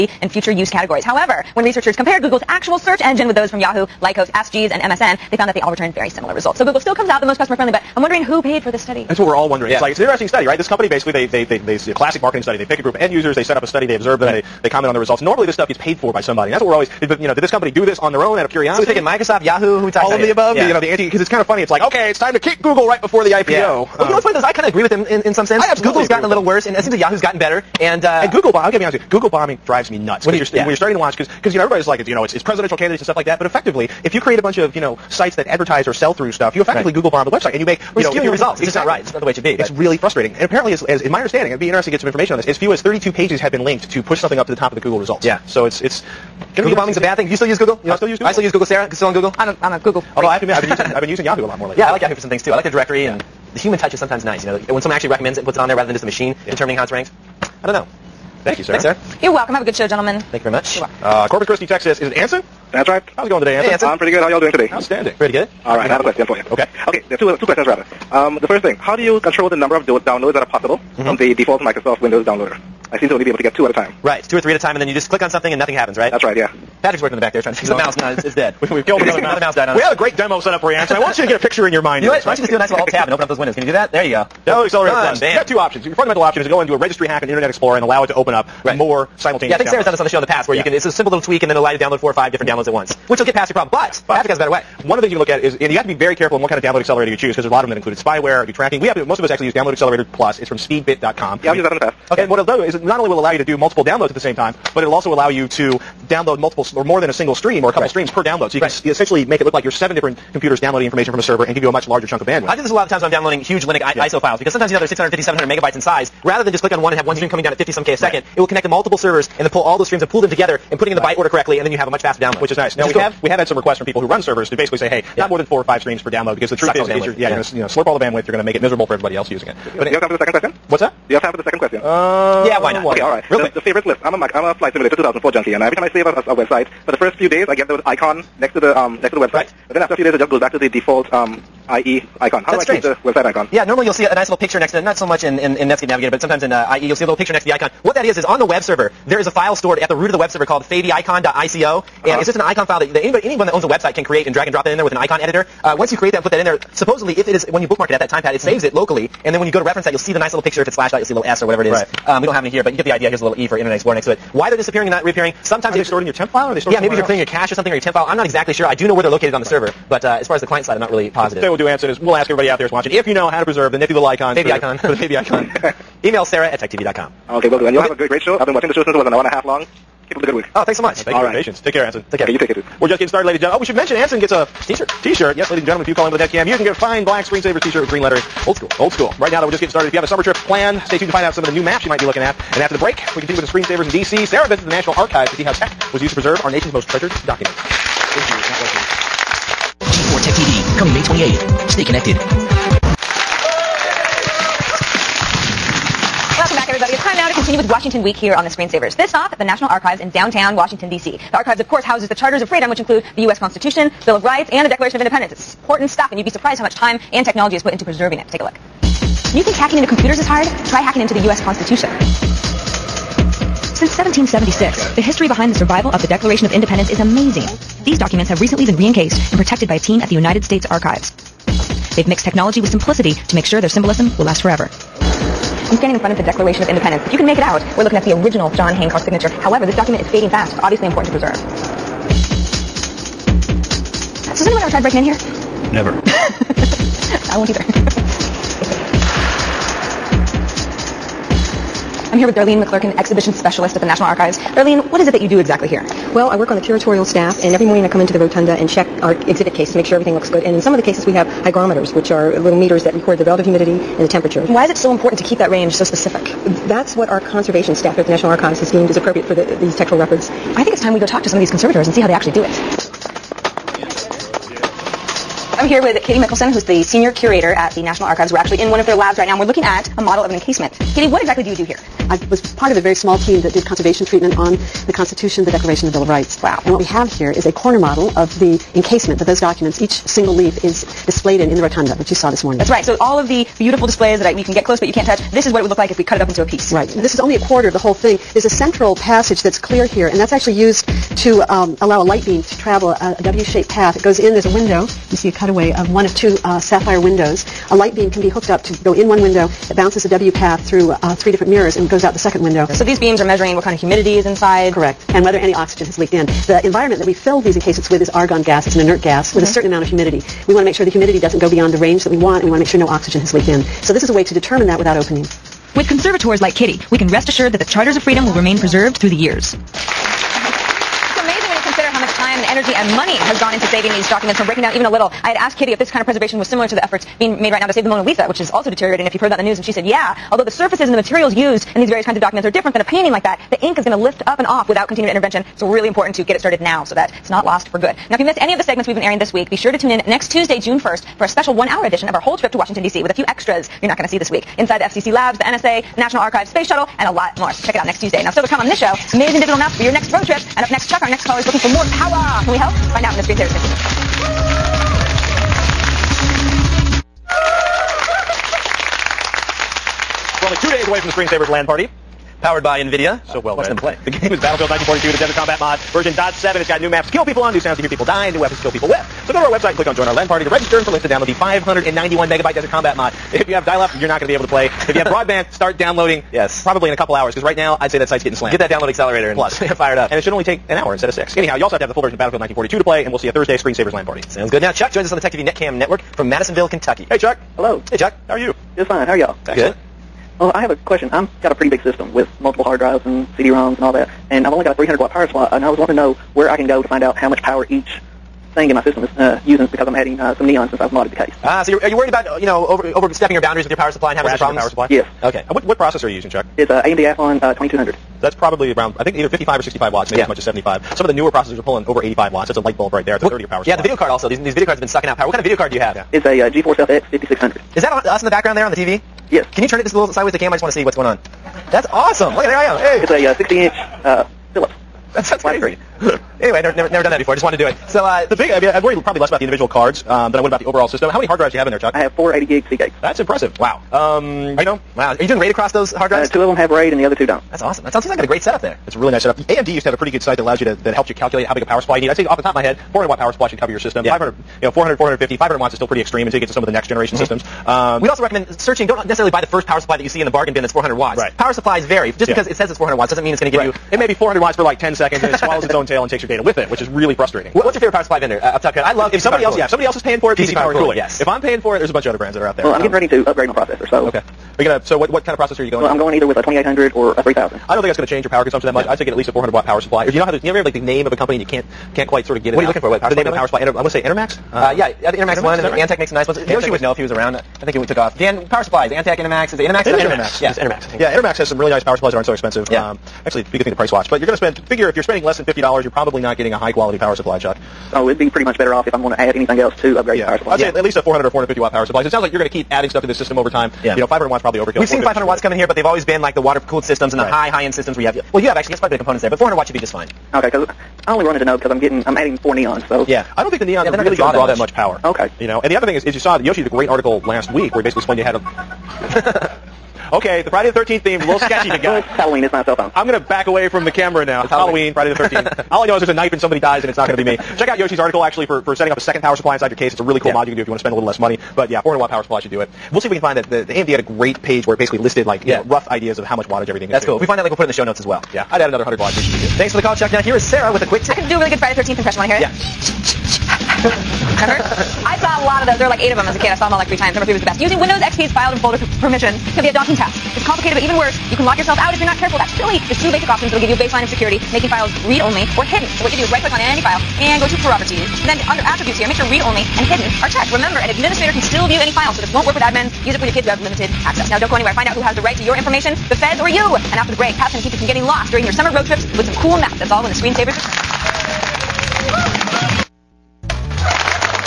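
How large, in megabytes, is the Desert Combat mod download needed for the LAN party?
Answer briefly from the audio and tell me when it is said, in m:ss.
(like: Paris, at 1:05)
591, at 6:21.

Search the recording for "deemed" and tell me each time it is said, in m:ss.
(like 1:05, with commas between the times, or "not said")
4:28.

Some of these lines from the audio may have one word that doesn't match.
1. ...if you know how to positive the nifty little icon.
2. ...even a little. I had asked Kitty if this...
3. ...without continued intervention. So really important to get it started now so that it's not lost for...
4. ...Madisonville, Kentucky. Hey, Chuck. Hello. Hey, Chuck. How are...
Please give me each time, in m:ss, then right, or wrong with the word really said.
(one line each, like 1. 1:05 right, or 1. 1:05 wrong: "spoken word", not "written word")
1. 2:52 wrong: "preserve", not "positive"
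2. 5:34 right
3. 5:44 right
4. 6:36 right.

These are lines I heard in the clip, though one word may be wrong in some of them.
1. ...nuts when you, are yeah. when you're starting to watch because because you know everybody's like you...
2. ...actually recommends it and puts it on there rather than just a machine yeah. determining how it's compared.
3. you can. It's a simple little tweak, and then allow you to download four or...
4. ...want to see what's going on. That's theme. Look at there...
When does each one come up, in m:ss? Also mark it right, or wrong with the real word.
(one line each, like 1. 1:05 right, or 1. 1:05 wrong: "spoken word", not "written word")
1. 0:29 right
2. 0:54 wrong: "ranked", not "compared"
3. 1:30 right
4. 7:10 wrong: "awesome", not "theme".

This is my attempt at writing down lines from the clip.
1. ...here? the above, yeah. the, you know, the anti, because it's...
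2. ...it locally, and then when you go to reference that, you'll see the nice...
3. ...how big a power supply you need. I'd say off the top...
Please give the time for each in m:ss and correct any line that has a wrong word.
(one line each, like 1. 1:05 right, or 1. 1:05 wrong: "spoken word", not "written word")
1. 0:20 right
2. 2:38 right
3. 7:31 right.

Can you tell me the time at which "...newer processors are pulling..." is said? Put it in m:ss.
7:01.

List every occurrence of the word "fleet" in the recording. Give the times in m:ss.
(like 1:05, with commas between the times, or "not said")
not said.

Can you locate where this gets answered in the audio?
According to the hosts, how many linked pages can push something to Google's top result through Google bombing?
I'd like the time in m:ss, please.
0:42.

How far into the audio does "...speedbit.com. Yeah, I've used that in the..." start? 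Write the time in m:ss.
1:40.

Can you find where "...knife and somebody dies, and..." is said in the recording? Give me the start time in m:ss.
8:46.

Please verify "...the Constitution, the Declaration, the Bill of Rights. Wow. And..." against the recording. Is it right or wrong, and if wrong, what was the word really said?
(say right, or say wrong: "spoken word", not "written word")
right.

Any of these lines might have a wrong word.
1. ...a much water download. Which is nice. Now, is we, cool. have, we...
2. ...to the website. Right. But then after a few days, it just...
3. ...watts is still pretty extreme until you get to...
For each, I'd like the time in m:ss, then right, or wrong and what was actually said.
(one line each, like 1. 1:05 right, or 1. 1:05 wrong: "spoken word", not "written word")
1. 2:01 wrong: "faster", not "water"
2. 2:19 right
3. 7:35 right.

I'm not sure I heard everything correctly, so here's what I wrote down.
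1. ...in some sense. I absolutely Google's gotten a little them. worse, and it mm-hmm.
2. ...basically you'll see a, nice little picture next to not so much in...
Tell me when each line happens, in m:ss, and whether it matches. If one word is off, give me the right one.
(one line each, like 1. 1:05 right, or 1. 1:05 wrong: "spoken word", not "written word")
1. 0:25 right
2. 2:23 wrong: "normally", not "basically".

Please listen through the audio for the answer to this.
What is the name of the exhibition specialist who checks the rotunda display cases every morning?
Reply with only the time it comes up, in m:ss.
4:12.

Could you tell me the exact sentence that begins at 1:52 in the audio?
I do this a lot of the times when I'm downloading huge Linux I- yeah.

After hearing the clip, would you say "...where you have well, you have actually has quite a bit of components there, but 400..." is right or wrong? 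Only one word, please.
right.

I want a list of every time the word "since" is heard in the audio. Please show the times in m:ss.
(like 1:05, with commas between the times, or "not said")
2:58, 3:43, 6:50.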